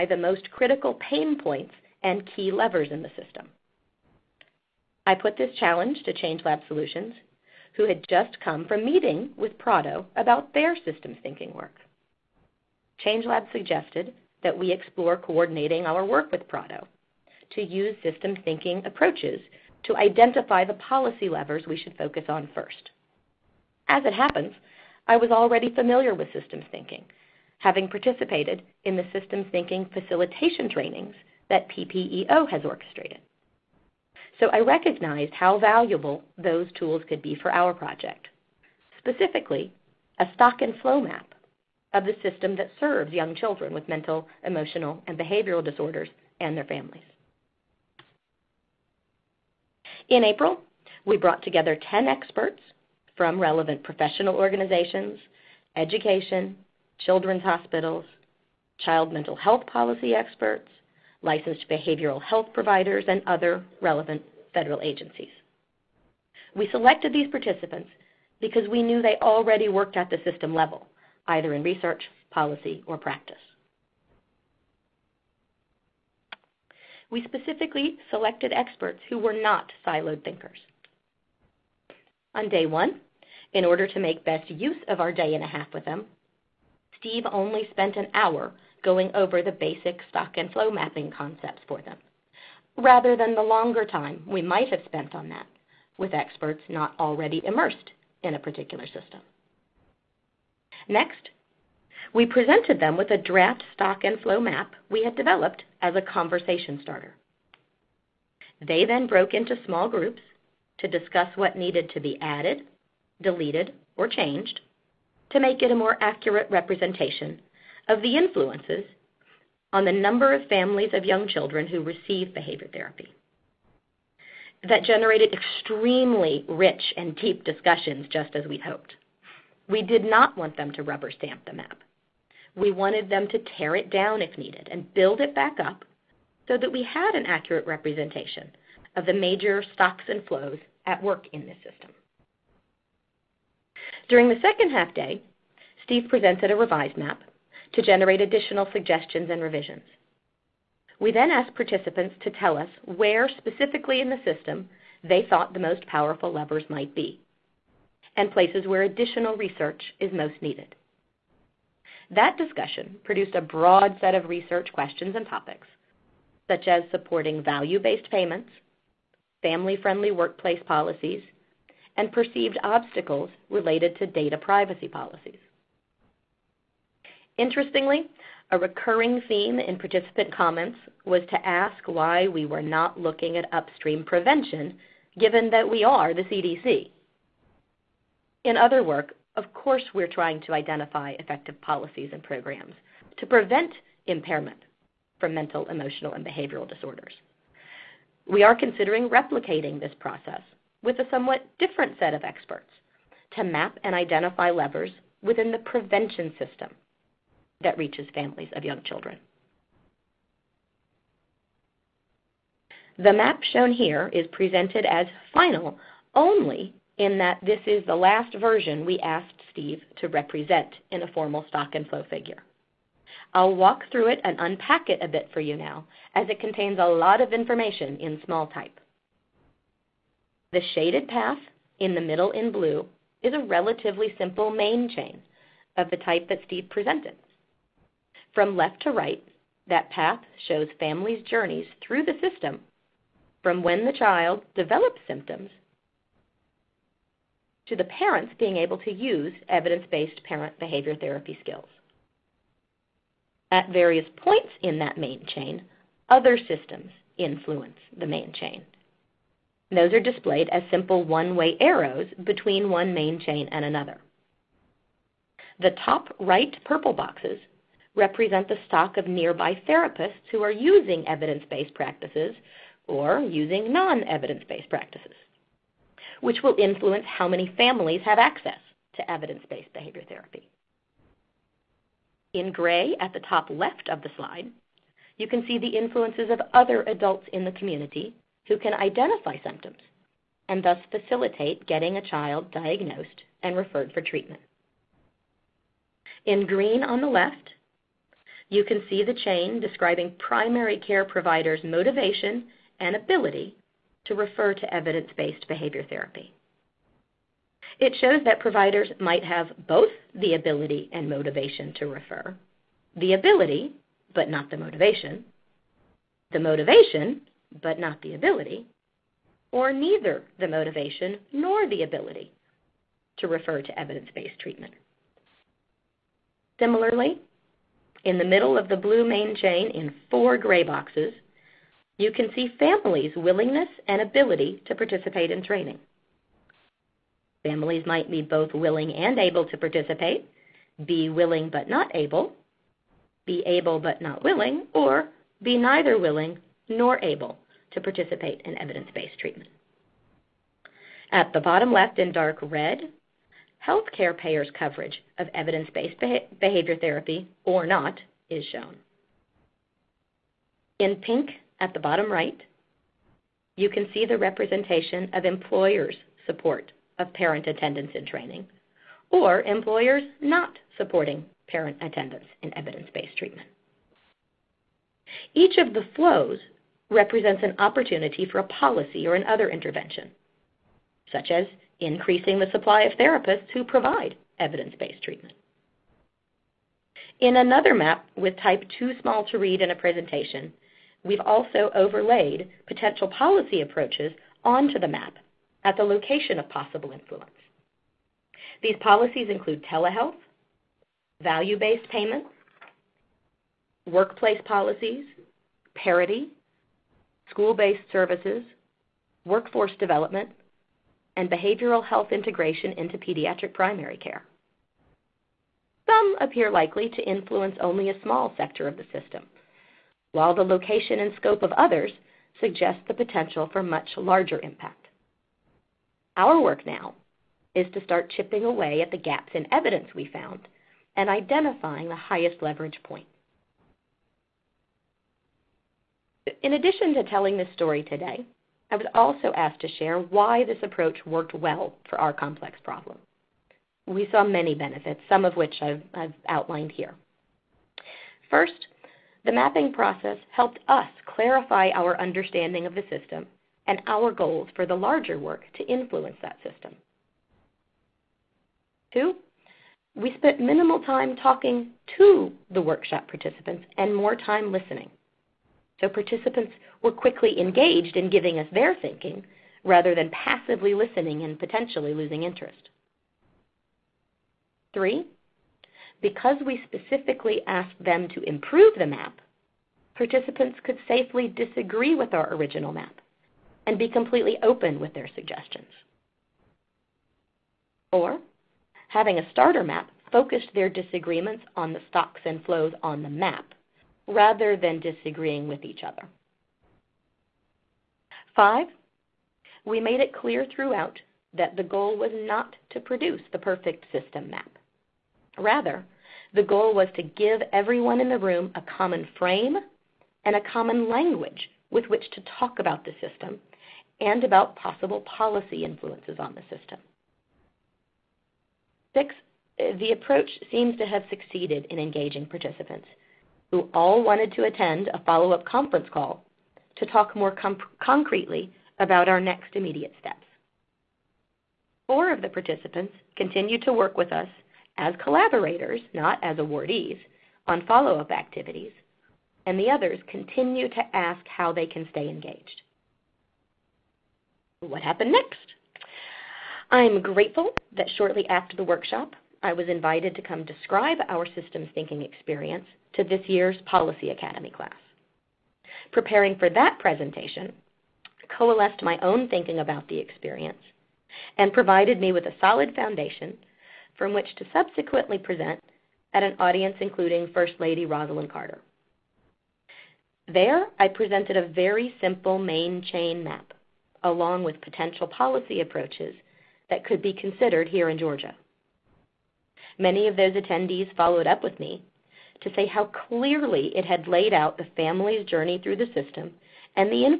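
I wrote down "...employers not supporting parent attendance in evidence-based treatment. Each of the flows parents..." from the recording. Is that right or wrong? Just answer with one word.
wrong.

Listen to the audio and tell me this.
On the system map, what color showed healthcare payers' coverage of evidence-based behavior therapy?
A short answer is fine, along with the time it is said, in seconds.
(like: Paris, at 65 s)
Dark red, at 352 s.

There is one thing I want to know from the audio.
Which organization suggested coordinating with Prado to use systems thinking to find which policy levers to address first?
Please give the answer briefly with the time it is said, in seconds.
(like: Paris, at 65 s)
ChangeLab Solutions, at 6 s.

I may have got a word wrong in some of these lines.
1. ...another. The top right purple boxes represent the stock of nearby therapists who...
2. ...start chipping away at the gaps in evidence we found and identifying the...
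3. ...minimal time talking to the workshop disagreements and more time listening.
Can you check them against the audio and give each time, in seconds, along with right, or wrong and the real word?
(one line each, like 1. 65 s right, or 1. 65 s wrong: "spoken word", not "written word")
1. 263 s right
2. 427 s right
3. 460 s wrong: "participants", not "disagreements".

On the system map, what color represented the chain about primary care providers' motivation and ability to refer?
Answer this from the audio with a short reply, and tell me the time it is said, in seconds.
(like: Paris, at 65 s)
Green, at 296 s.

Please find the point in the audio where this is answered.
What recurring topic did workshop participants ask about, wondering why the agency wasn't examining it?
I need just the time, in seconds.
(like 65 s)
183 s.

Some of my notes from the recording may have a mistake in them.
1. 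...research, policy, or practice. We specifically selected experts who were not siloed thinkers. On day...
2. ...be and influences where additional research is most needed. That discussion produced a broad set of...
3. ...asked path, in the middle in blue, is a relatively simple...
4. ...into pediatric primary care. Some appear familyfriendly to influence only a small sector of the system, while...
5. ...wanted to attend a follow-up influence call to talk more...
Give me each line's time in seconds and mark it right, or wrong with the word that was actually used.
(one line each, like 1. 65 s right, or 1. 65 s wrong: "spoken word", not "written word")
1. 71 s right
2. 156 s wrong: "places", not "influences"
3. 230 s wrong: "shaded", not "asked"
4. 412 s wrong: "likely", not "familyfriendly"
5. 524 s wrong: "conference", not "influence".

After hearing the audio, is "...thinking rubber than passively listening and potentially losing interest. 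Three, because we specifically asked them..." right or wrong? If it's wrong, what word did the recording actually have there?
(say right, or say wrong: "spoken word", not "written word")
wrong: "rather", not "rubber".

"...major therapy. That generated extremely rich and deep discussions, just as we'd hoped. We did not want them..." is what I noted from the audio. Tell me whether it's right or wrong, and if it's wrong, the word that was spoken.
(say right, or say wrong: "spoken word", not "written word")
wrong: "behavior", not "major".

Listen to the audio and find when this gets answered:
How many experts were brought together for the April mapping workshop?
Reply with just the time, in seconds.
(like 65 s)
51 s.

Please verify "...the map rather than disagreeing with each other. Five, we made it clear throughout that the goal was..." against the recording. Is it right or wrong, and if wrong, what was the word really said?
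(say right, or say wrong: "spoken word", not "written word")
right.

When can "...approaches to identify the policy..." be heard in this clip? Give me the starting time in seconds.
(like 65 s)
18 s.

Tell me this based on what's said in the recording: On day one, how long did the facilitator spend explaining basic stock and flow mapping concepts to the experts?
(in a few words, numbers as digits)
An hour.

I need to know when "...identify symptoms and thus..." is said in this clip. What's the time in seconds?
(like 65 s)
288 s.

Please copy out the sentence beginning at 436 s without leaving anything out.
In addition to telling this story today, I was also asked to share why this approach worked well for our complex problem.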